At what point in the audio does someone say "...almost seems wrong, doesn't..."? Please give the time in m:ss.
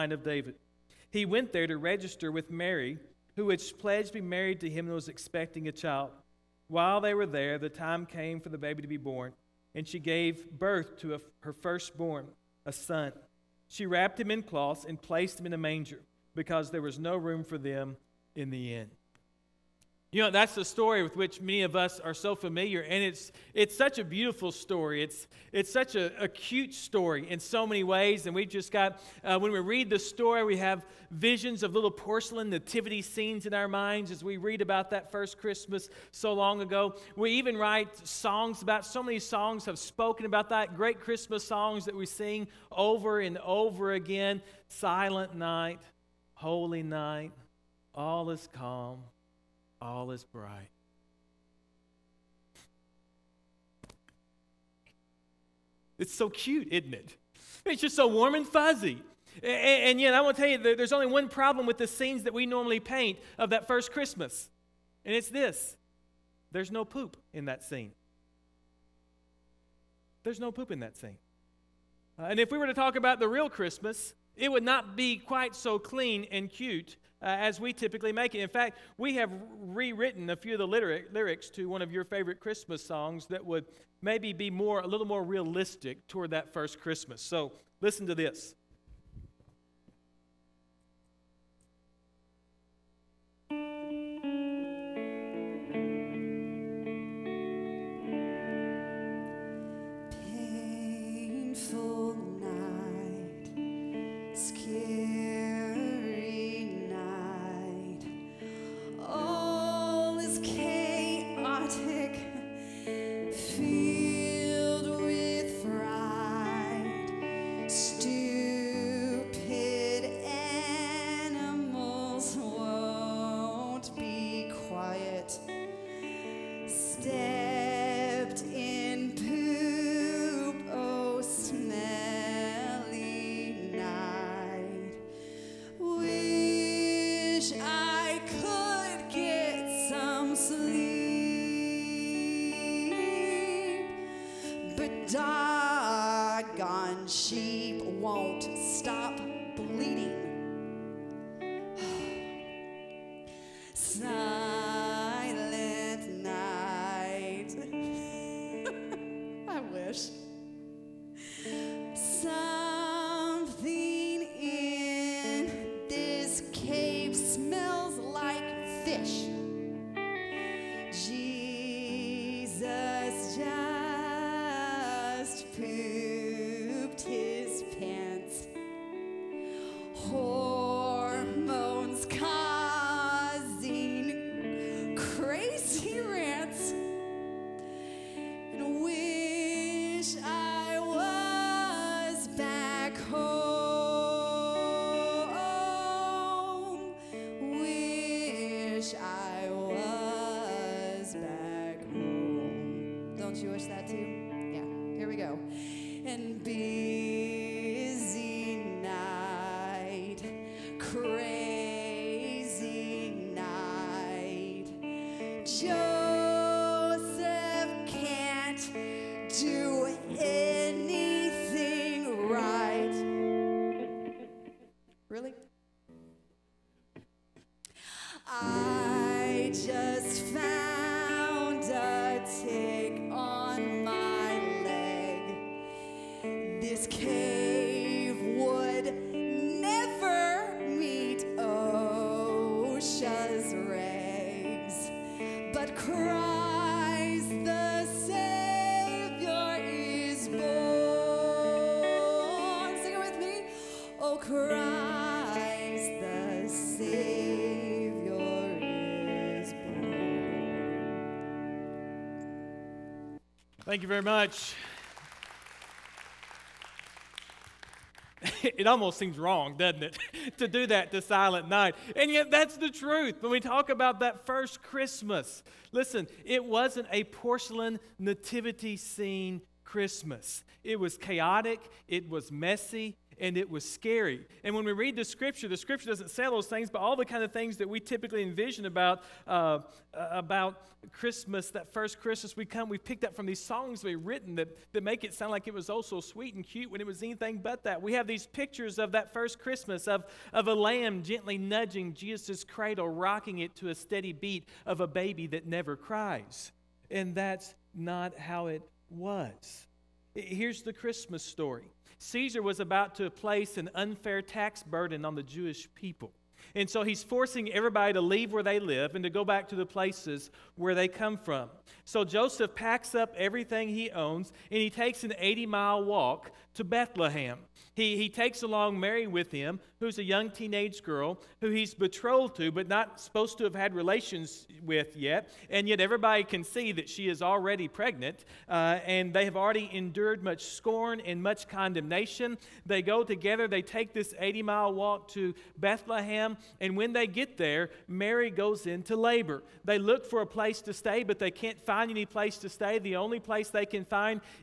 4:28.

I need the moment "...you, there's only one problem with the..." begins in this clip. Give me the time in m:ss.
1:00.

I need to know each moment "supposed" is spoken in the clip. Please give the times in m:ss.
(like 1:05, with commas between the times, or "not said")
5:32.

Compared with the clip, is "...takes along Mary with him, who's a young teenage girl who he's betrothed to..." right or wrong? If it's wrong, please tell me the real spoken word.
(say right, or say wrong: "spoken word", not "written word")
right.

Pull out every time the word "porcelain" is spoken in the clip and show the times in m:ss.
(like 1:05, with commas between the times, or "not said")
0:31, 4:37.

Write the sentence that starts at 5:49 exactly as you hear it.
They look for a place to stay, but they can't find any place to stay.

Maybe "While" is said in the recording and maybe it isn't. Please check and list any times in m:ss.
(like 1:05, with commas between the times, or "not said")
0:06.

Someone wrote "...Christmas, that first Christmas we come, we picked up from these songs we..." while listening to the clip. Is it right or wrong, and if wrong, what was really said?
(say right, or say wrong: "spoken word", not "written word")
right.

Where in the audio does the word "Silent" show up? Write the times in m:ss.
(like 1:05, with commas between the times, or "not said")
0:44, 4:31.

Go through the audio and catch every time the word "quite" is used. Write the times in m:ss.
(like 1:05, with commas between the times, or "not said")
1:15.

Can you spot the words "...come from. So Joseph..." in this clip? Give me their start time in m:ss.
5:20.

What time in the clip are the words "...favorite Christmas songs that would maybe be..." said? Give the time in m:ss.
1:22.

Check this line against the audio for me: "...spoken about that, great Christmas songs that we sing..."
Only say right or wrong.
right.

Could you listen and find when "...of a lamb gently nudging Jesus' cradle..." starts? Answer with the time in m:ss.
5:00.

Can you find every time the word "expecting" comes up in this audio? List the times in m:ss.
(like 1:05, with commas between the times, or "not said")
0:05.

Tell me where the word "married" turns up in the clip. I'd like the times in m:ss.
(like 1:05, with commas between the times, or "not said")
0:04.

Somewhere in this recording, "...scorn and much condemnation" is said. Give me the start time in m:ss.
5:40.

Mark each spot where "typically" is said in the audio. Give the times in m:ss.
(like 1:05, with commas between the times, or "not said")
1:17, 4:47.